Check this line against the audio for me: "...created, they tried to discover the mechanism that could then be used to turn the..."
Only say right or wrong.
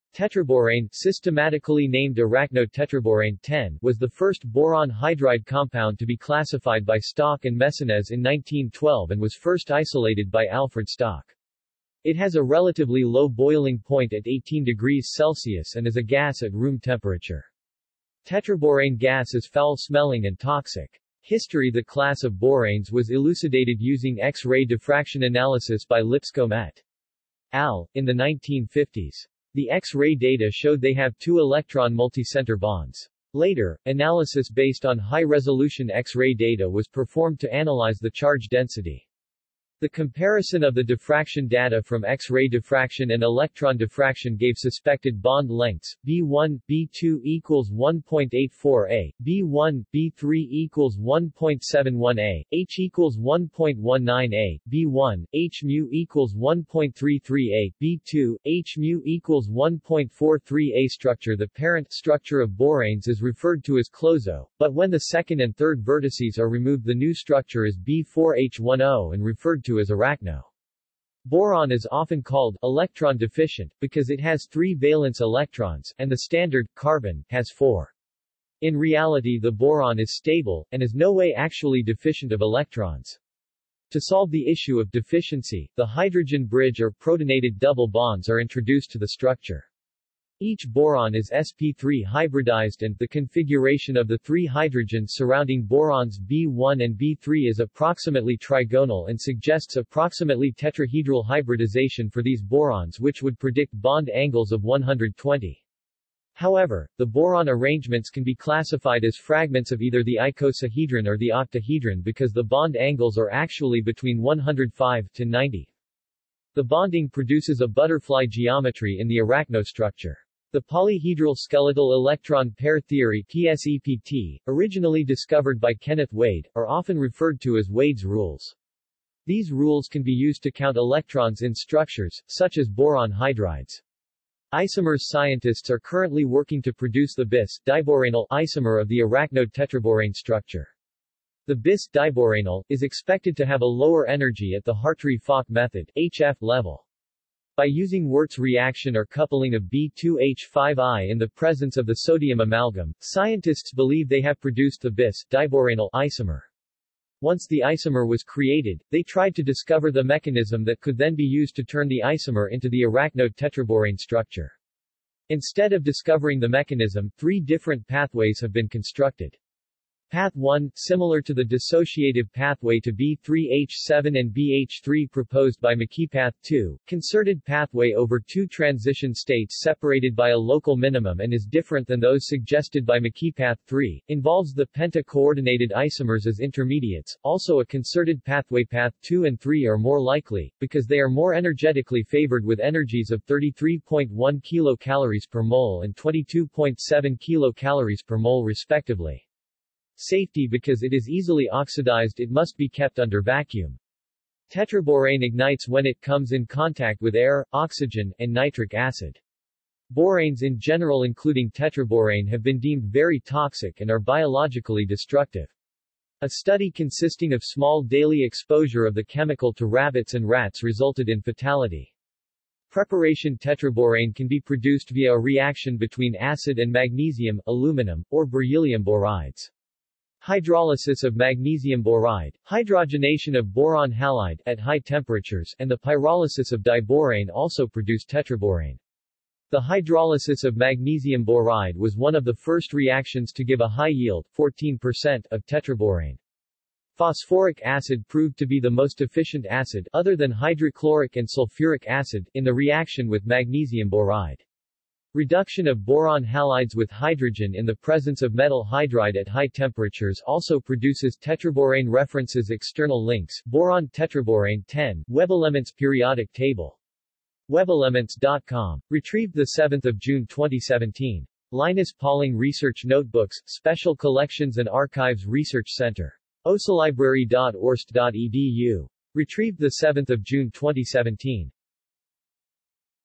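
right.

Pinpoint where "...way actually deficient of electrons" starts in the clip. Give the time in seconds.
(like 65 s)
81 s.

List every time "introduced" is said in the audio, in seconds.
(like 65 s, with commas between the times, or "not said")
88 s.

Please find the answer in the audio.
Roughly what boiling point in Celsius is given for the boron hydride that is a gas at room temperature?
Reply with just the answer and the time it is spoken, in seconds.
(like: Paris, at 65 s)
18 degrees Celsius, at 14 s.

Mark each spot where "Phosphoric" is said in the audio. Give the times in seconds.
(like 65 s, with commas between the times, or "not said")
246 s.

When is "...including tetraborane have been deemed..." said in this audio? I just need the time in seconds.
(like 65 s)
211 s.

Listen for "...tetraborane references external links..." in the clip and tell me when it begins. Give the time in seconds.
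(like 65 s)
261 s.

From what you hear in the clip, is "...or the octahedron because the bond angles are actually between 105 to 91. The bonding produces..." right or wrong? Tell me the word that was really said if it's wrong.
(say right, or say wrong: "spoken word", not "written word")
wrong: "90", not "91".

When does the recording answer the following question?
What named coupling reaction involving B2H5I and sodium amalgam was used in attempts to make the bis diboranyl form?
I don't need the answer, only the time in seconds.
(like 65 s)
148 s.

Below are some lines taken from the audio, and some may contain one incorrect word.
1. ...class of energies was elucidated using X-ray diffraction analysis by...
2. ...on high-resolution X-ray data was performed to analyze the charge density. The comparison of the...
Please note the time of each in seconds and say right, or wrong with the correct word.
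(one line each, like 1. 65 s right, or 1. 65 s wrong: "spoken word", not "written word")
1. 21 s wrong: "boranes", not "energies"
2. 34 s right.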